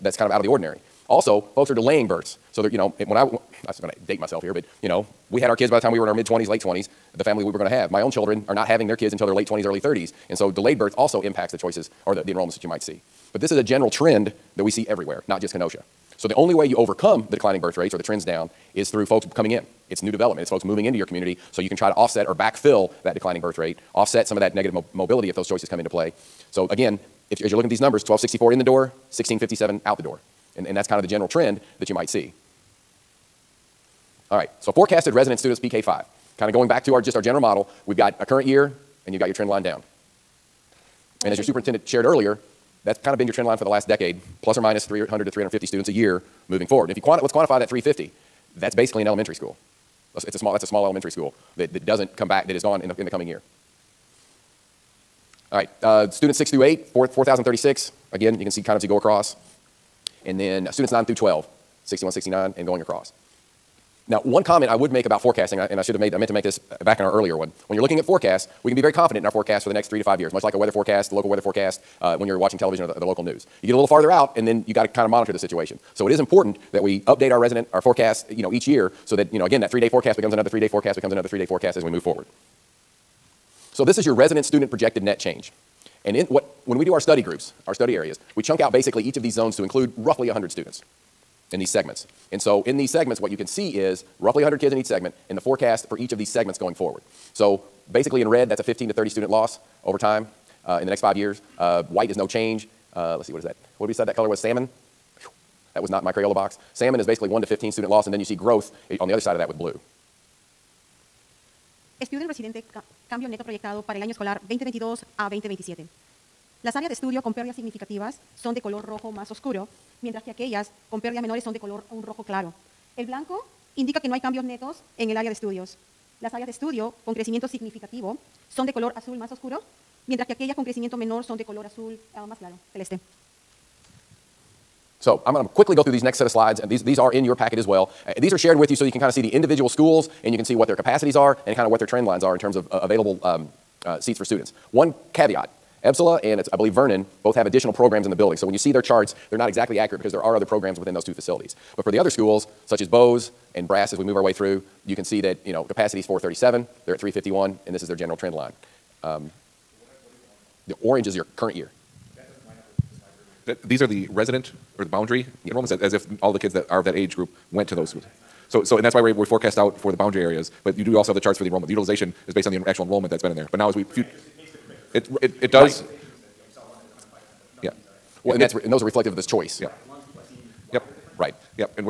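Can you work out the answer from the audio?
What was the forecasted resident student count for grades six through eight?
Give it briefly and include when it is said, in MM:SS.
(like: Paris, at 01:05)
4,036, at 00:56.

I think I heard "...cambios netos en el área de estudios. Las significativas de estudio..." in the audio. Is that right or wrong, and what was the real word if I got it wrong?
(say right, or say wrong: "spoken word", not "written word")
wrong: "áreas", not "significativas".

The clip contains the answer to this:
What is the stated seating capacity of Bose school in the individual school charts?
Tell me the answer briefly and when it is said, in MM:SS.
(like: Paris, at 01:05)
437, at 02:36.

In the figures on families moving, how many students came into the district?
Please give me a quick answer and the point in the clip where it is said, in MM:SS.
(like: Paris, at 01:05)
1264, at 00:28.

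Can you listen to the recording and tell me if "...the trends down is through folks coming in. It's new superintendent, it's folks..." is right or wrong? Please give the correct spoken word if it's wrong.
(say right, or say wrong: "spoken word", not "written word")
wrong: "development", not "superintendent".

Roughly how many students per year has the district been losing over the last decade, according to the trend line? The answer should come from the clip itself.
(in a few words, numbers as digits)
300 to 350.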